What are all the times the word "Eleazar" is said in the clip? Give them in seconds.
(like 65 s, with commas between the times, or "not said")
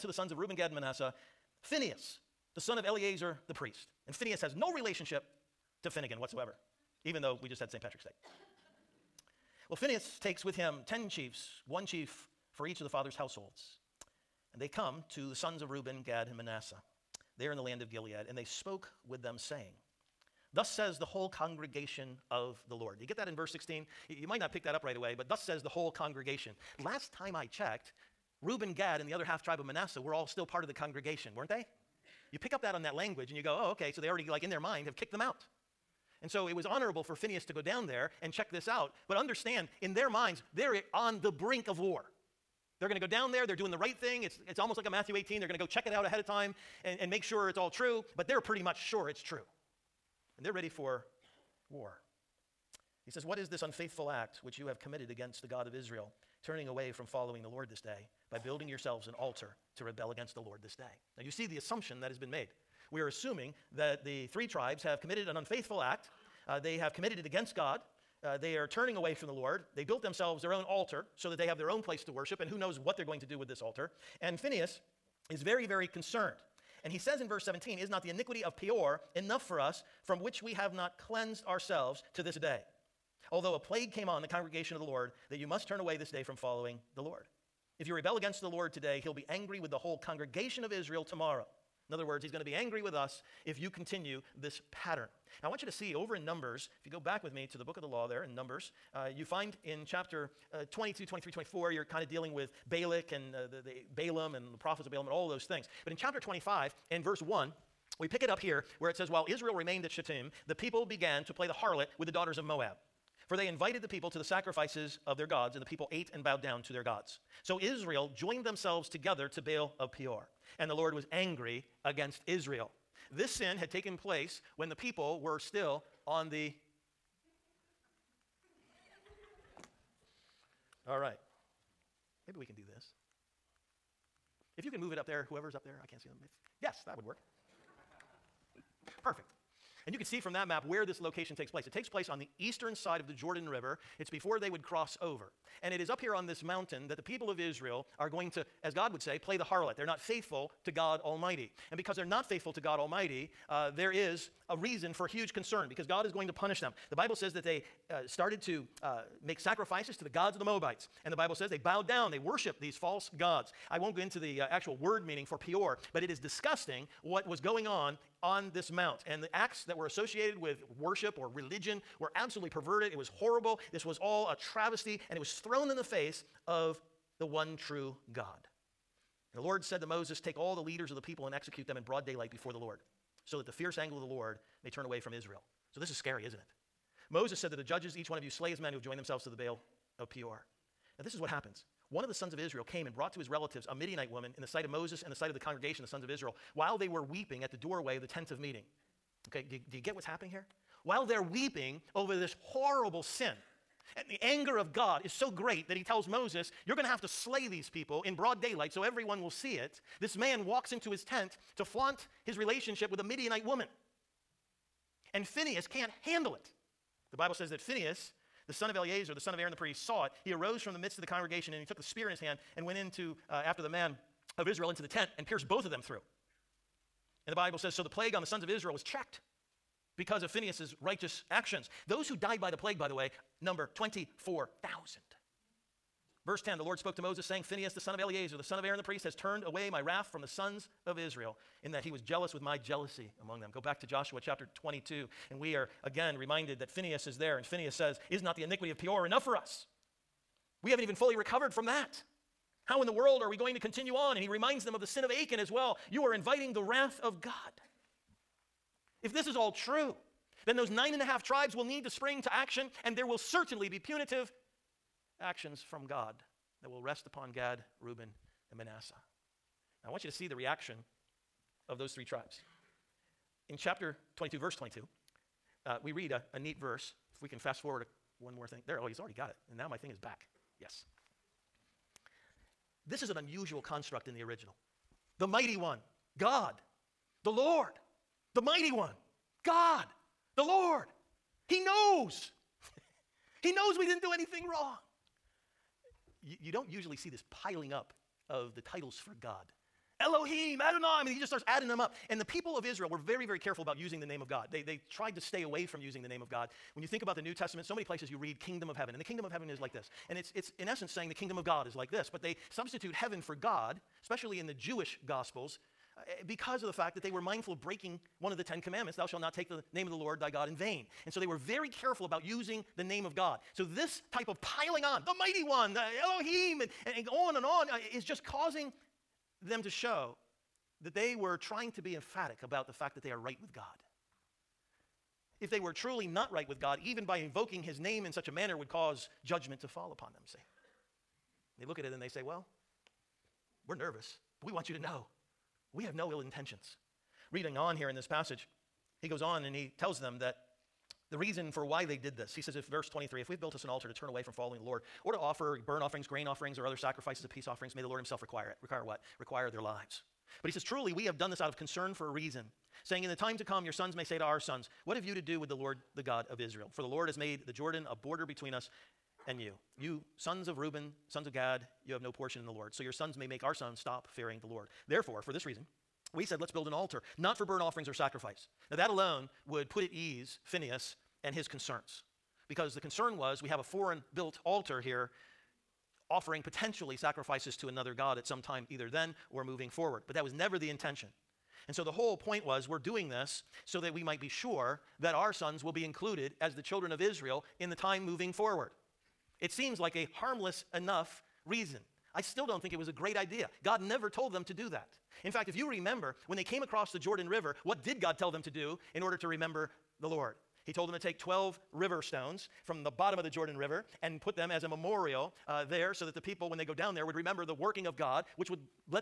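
2 s, 218 s, 237 s.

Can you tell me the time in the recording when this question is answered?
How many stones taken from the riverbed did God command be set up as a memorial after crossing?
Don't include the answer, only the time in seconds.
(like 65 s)
411 s.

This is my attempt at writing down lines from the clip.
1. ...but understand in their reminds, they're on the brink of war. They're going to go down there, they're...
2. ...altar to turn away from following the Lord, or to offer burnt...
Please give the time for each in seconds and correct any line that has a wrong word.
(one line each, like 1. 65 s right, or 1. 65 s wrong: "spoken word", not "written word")
1. 39 s wrong: "minds", not "reminds"
2. 353 s right.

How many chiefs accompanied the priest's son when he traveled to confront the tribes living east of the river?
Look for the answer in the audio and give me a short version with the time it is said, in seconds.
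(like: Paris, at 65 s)
10, at 10 s.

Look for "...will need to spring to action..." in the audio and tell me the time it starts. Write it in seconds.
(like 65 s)
261 s.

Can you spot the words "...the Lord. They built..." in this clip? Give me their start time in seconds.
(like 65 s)
69 s.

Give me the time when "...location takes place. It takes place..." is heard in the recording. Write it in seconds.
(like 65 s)
141 s.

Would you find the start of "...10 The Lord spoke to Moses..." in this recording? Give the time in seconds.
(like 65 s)
236 s.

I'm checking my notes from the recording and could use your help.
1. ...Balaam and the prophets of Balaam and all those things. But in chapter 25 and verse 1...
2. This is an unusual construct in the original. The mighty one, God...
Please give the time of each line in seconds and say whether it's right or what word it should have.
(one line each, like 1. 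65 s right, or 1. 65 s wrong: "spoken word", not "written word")
1. 103 s right
2. 282 s right.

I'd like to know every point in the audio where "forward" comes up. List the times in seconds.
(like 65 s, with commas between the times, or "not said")
277 s, 389 s, 398 s.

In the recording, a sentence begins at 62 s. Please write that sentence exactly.
We are assuming that the three tribes have committed an unfaithful act.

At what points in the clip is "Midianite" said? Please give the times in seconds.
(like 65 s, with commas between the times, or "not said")
193 s, 213 s.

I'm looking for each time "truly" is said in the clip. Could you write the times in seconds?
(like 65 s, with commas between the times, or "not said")
335 s, 360 s.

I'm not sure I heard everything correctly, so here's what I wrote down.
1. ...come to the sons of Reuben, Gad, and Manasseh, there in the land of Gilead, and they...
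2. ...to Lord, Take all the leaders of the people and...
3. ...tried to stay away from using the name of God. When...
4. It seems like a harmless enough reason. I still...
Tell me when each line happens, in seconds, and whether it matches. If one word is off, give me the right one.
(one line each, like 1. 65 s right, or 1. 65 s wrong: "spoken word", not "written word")
1. 14 s right
2. 179 s wrong: "Moses", not "Lord"
3. 304 s right
4. 399 s right.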